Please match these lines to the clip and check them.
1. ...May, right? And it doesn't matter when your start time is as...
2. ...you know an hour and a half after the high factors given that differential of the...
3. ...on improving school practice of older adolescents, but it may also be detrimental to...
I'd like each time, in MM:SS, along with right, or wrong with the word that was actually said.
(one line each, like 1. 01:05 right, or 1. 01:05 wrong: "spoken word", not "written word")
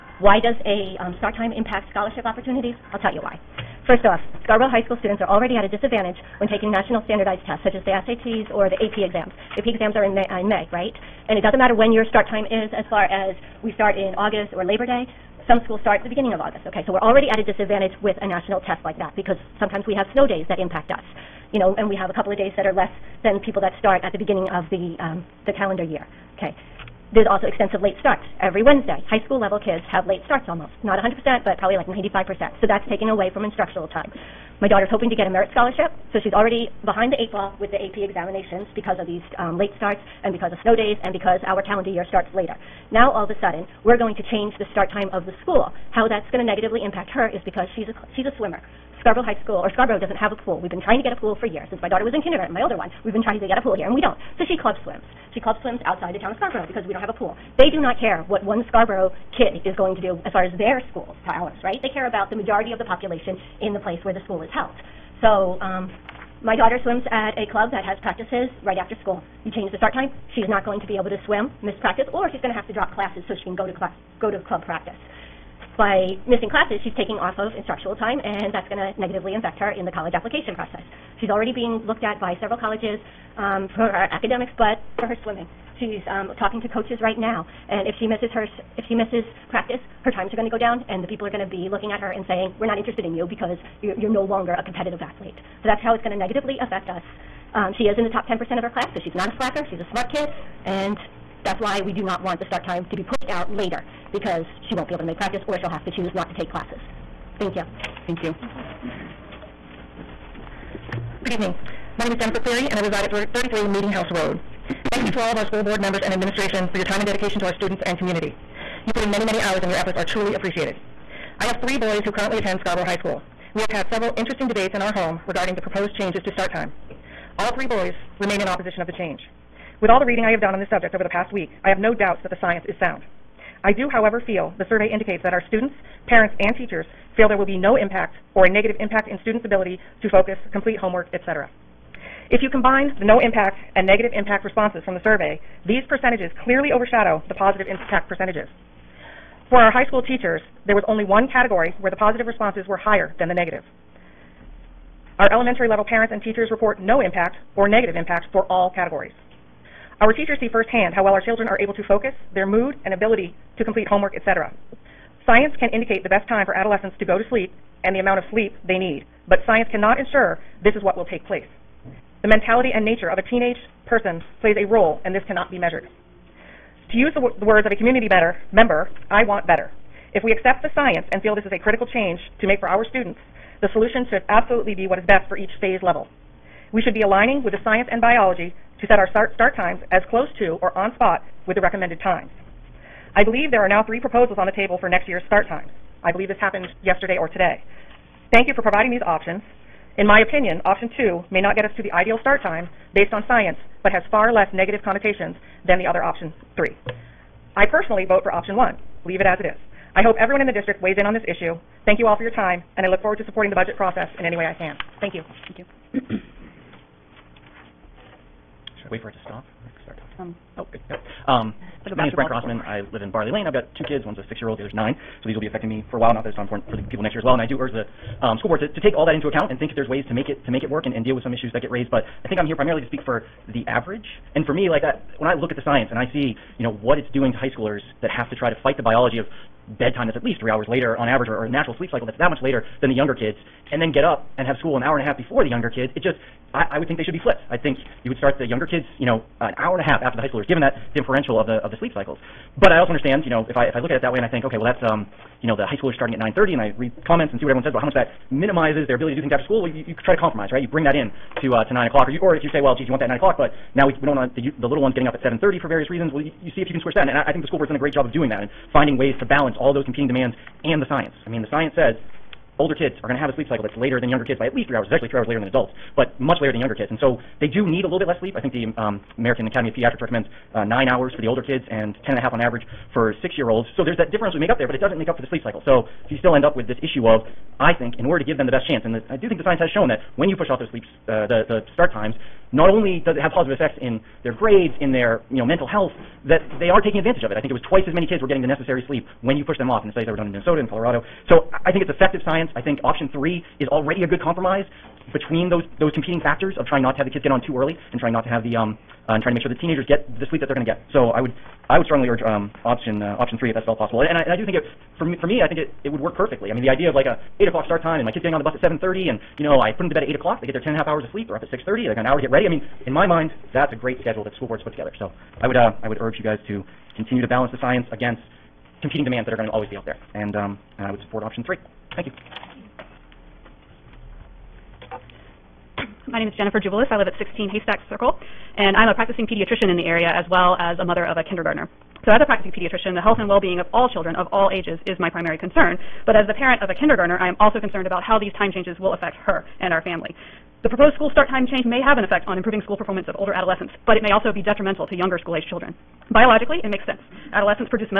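1. 00:10 right
2. 04:08 wrong: "schoolers", not "factors"
3. 05:52 wrong: "performance", not "practice".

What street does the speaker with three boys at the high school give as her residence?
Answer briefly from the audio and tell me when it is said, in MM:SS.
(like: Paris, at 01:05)
Meeting House Road, at 01:53.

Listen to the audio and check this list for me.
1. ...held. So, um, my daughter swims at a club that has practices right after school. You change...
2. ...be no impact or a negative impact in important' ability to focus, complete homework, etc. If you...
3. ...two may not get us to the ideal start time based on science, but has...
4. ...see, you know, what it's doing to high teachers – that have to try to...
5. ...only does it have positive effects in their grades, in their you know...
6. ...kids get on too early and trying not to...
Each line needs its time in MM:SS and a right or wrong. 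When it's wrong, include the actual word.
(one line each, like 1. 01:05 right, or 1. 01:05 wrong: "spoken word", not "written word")
1. 01:04 right
2. 02:17 wrong: "students", not "important"
3. 03:20 right
4. 03:56 wrong: "schoolers", not "teachers"
5. 04:52 right
6. 05:07 right.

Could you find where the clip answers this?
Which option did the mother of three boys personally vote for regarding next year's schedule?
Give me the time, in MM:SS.
03:28.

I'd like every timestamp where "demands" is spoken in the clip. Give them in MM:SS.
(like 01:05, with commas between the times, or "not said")
04:30, 05:29.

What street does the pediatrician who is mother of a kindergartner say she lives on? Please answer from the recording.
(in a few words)
Haystack Circle.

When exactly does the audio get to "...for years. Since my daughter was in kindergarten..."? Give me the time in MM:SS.
00:51.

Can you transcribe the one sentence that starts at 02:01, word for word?
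I have three boys who currently attend Scarborough High School.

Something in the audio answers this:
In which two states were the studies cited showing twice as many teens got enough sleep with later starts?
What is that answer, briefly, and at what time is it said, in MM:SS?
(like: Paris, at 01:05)
Minnesota and Colorado, at 05:00.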